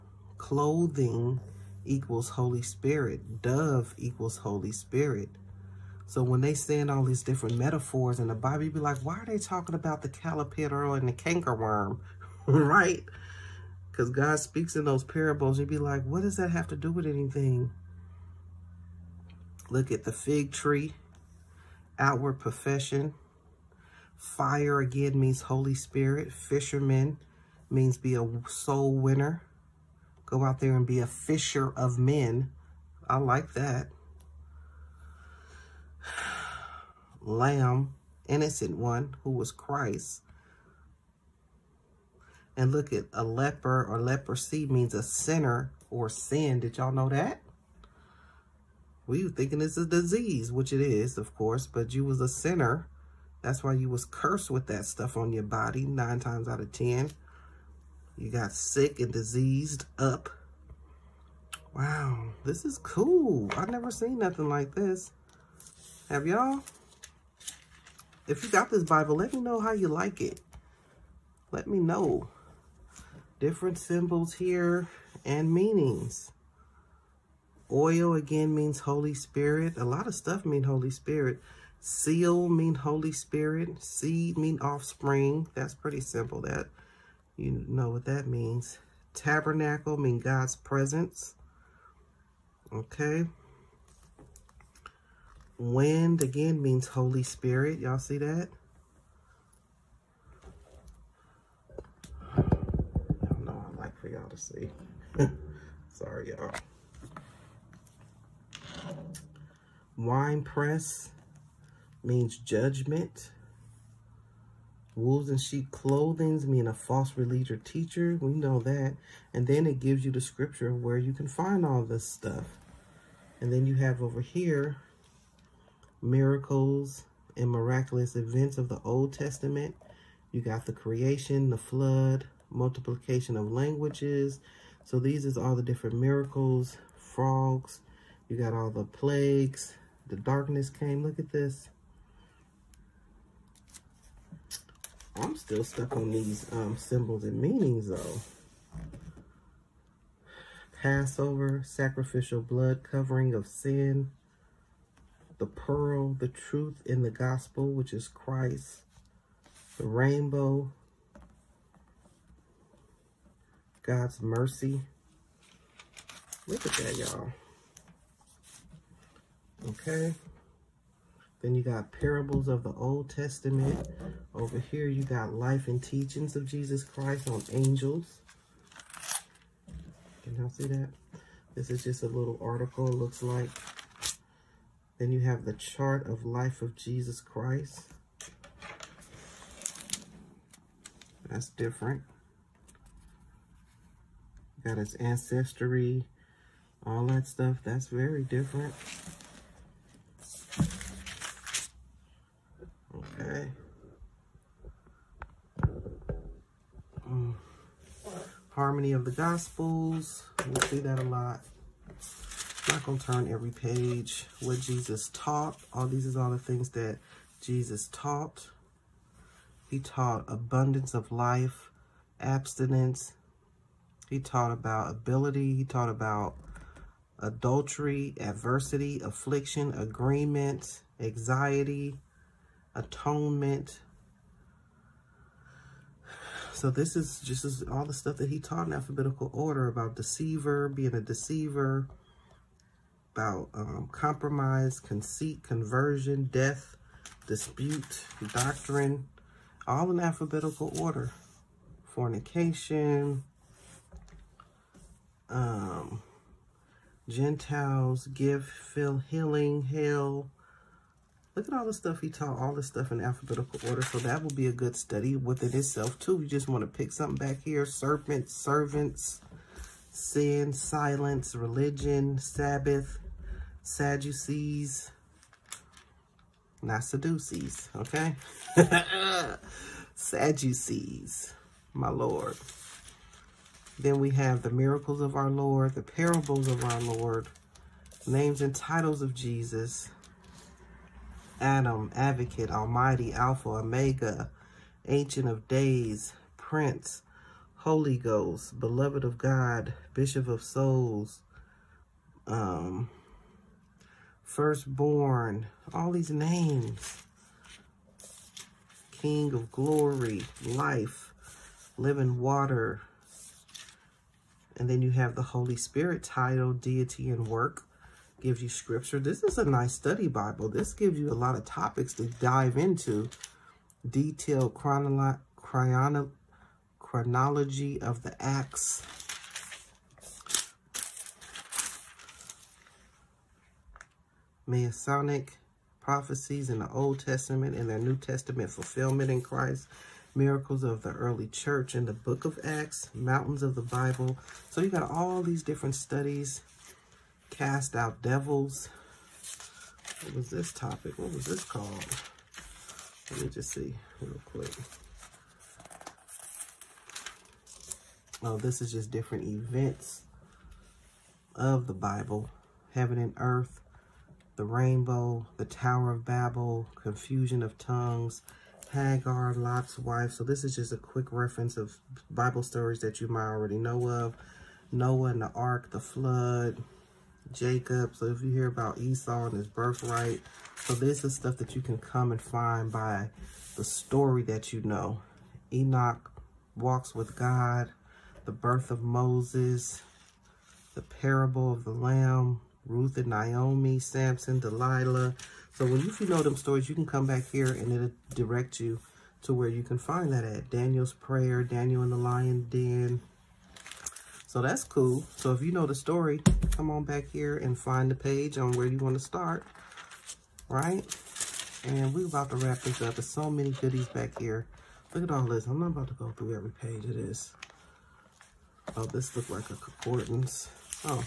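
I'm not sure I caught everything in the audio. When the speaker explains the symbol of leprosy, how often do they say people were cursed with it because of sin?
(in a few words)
9 times out of 10.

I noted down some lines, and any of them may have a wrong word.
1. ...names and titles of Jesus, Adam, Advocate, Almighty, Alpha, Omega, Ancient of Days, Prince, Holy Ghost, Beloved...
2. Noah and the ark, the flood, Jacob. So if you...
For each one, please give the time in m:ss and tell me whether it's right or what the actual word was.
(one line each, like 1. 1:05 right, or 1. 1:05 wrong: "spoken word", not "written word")
1. 4:48 right
2. 6:14 right.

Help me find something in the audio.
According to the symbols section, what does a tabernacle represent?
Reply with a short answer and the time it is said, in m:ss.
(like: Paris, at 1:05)
God's presence, at 1:30.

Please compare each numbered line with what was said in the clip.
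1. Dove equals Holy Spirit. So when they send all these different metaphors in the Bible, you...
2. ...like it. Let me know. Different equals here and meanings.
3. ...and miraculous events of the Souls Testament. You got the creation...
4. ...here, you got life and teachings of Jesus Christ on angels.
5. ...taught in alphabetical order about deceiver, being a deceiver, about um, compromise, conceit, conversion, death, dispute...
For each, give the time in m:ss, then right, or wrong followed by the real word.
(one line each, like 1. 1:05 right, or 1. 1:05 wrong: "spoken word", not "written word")
1. 0:03 right
2. 1:09 wrong: "symbols", not "equals"
3. 2:07 wrong: "Old", not "Souls"
4. 2:54 right
5. 3:58 right.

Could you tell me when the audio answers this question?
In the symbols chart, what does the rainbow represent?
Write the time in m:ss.
2:43.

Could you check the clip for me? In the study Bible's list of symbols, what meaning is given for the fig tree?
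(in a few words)
Outward profession.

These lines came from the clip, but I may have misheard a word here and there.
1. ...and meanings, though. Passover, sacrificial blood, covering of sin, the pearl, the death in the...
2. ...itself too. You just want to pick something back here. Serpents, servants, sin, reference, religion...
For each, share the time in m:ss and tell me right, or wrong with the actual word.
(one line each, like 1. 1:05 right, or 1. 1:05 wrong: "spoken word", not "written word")
1. 2:27 wrong: "truth", not "death"
2. 4:25 wrong: "silence", not "reference".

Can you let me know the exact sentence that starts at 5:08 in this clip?
King of glory, life, living water.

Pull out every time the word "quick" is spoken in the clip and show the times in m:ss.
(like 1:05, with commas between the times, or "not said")
5:54, 6:10.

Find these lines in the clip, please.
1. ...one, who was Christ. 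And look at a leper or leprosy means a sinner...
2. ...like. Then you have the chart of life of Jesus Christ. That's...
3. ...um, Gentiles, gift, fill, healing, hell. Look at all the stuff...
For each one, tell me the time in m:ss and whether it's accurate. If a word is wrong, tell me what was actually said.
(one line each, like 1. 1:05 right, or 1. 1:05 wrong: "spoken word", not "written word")
1. 0:38 right
2. 3:03 right
3. 4:15 right.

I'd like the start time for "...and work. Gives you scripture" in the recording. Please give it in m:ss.
5:17.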